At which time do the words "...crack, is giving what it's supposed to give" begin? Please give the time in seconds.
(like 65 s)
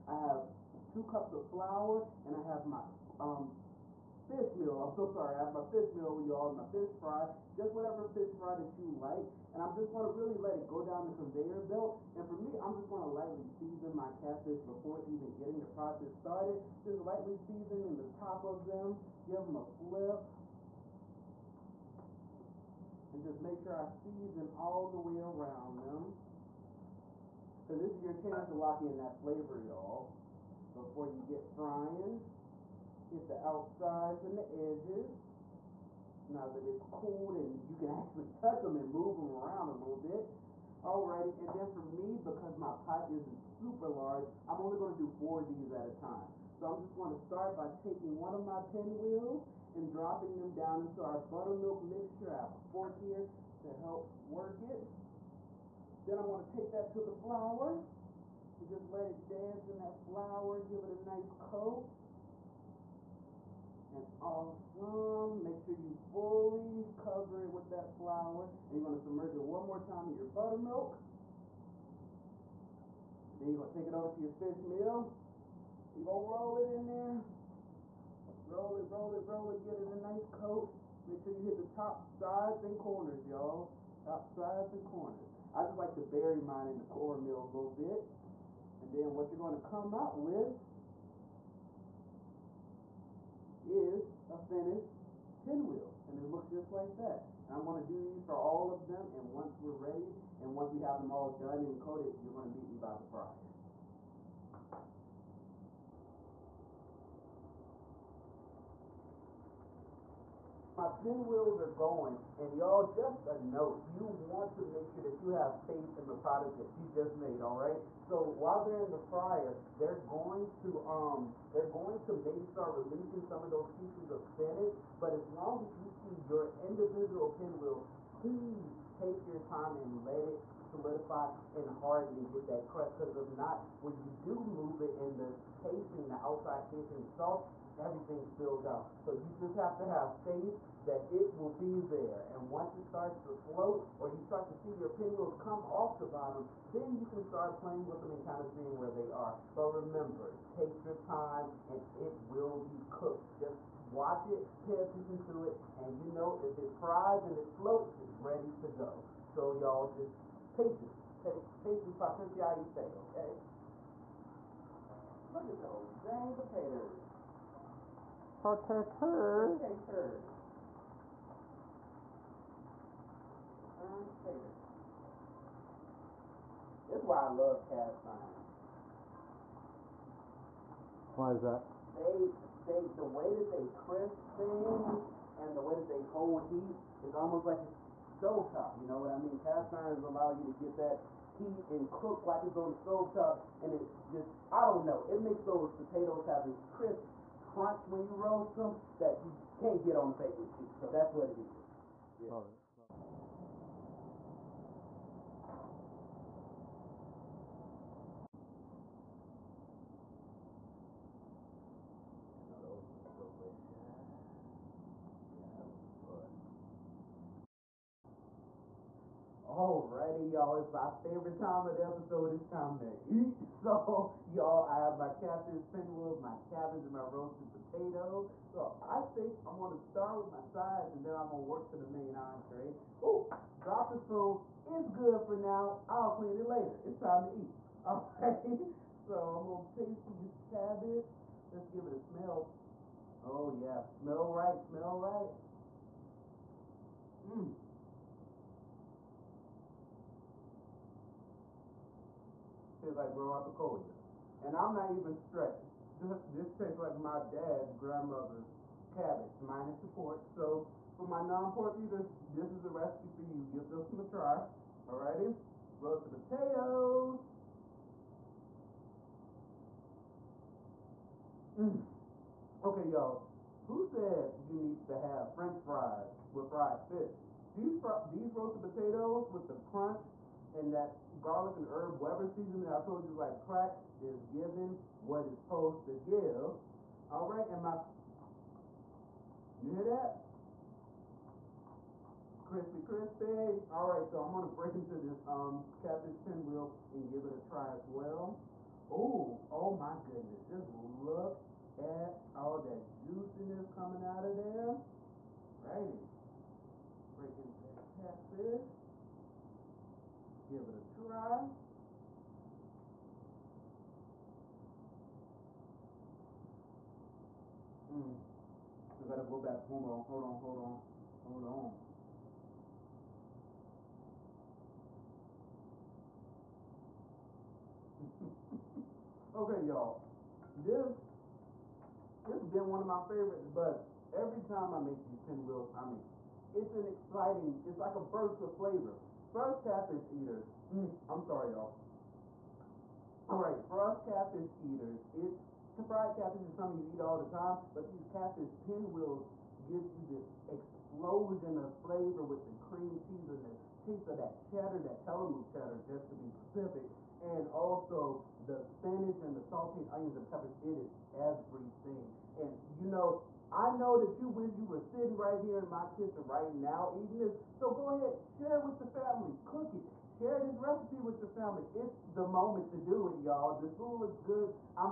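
283 s.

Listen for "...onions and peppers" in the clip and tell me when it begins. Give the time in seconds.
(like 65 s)
359 s.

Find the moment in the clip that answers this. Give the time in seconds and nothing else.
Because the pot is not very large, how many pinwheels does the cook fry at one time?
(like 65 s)
45 s.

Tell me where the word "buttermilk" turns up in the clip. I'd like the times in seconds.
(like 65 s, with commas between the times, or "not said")
51 s, 70 s.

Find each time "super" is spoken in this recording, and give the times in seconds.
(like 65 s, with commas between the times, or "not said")
43 s.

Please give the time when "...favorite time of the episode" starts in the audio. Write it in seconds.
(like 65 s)
221 s.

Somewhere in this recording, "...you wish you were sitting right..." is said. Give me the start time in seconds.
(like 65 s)
364 s.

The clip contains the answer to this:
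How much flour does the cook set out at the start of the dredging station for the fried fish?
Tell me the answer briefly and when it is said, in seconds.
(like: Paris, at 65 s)
2 cups, at 0 s.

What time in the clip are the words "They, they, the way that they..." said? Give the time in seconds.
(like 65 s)
181 s.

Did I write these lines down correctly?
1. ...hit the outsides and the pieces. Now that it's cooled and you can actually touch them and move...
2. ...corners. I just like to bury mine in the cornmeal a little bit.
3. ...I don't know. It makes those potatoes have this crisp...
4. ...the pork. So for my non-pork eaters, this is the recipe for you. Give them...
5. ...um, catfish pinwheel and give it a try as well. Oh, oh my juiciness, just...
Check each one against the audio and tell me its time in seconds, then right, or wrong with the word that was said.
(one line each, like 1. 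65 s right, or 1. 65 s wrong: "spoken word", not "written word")
1. 33 s wrong: "edges", not "pieces"
2. 84 s right
3. 194 s right
4. 259 s right
5. 295 s wrong: "goodness", not "juiciness".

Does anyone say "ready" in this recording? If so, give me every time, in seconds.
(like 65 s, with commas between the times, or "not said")
99 s, 158 s.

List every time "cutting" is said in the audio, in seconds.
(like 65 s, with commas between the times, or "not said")
not said.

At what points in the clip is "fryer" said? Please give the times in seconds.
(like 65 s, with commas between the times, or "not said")
103 s, 119 s.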